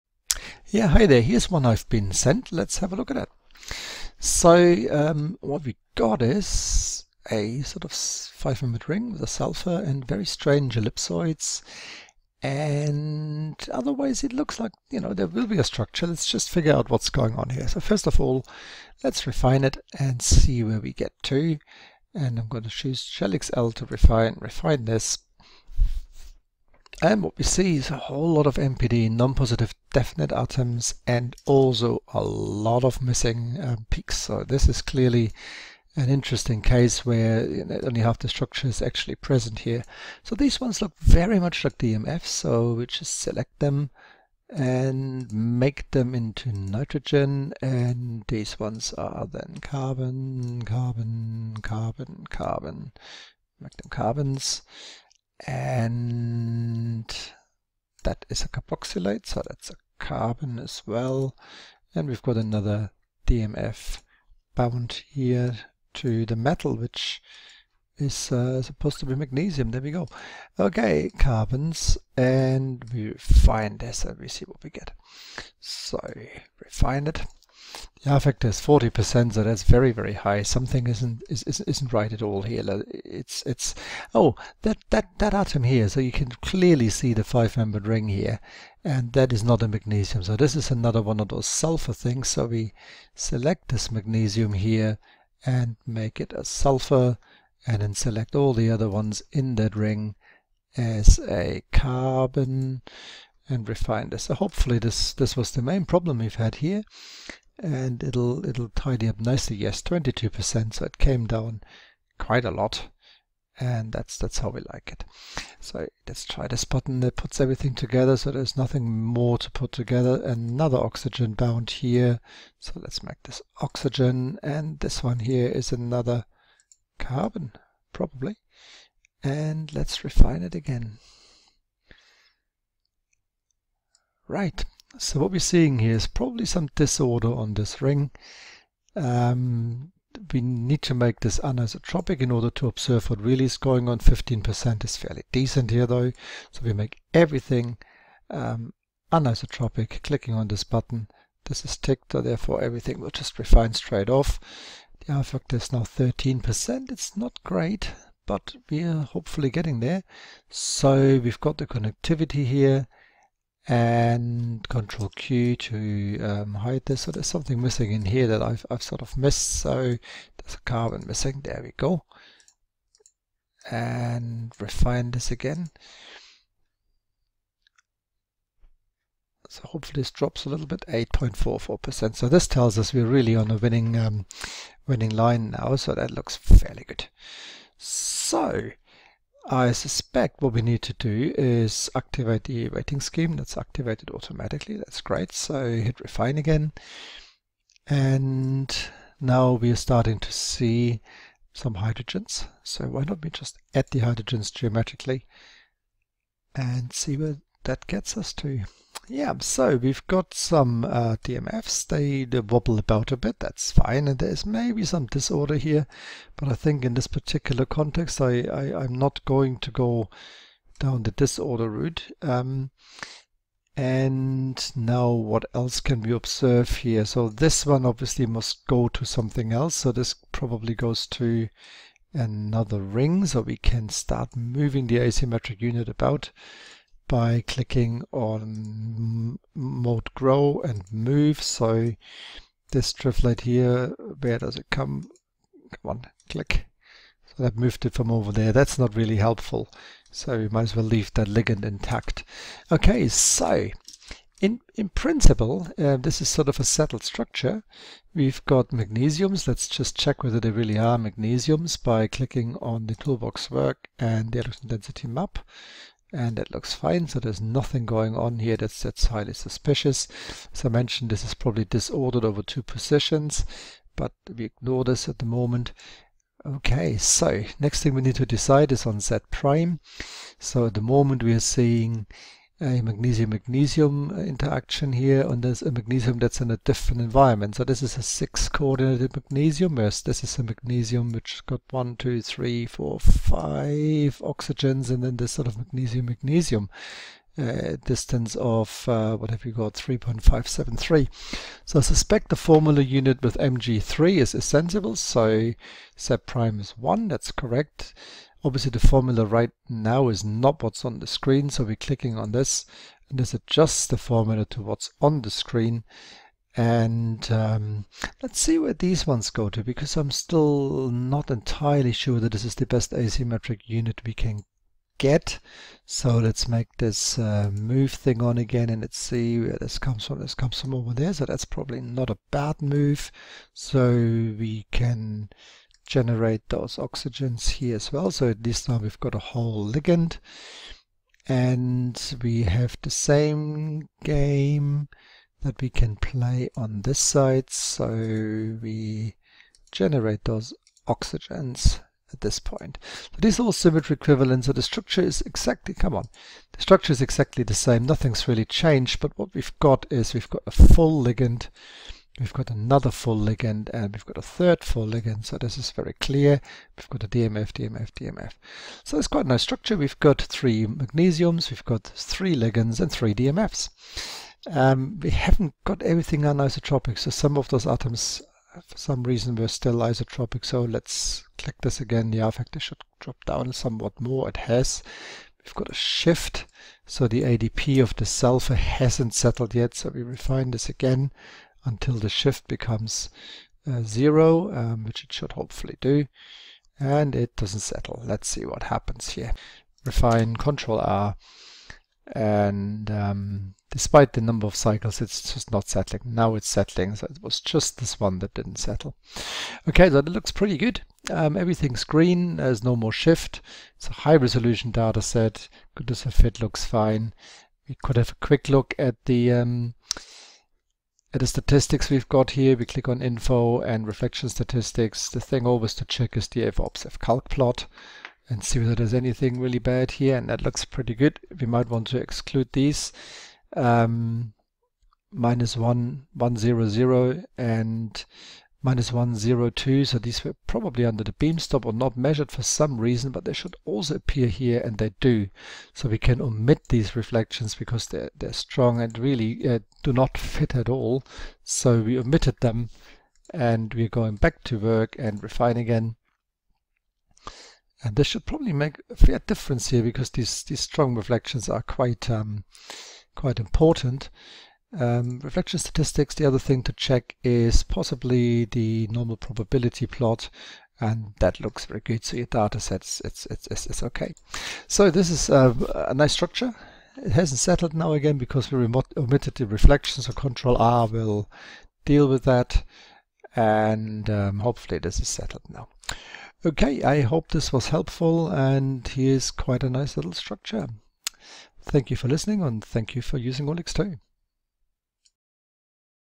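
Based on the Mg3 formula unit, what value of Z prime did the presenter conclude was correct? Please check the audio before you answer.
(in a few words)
1.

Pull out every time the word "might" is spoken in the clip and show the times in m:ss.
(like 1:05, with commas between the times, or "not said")
4:10, 7:11.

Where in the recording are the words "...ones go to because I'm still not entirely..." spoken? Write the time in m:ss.
5:19.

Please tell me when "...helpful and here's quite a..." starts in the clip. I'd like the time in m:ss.
8:07.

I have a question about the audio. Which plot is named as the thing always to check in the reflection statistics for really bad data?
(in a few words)
Fobs calc plot.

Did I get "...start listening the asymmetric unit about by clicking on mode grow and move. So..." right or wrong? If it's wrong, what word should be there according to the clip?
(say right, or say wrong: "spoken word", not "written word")
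wrong: "moving", not "listening".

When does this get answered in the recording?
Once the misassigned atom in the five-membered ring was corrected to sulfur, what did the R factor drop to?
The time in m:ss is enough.
1:49.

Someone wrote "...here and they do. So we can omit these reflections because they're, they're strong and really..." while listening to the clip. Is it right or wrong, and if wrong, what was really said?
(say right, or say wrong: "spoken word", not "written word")
right.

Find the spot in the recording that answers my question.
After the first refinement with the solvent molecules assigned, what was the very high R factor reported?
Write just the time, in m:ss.
1:18.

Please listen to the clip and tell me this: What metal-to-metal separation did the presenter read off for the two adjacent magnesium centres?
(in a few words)
3.573.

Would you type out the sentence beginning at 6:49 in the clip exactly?
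Okay, so it looks pretty good.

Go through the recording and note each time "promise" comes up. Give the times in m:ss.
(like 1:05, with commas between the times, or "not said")
not said.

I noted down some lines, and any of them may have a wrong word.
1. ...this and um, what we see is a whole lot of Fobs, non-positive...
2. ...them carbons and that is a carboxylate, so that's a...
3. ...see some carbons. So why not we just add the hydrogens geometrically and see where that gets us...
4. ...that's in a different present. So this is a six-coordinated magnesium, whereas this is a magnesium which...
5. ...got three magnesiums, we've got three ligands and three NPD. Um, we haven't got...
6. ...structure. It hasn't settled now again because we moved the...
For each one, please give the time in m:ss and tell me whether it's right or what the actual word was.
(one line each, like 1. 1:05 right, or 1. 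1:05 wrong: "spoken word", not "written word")
1. 0:24 wrong: "NPD", not "Fobs"
2. 0:53 right
3. 3:20 wrong: "hydrogens", not "carbons"
4. 4:46 wrong: "environment", not "present"
5. 6:09 wrong: "DMFs", not "NPD"
6. 7:56 wrong: "omitted", not "moved".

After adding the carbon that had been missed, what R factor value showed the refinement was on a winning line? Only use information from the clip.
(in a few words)
8.44%.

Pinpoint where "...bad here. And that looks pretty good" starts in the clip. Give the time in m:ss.
7:09.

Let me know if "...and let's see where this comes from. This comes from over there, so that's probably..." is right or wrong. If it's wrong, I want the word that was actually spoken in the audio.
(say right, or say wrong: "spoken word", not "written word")
right.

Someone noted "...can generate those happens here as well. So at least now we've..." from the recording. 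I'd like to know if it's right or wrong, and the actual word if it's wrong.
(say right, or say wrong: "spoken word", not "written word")
wrong: "oxygens", not "happens".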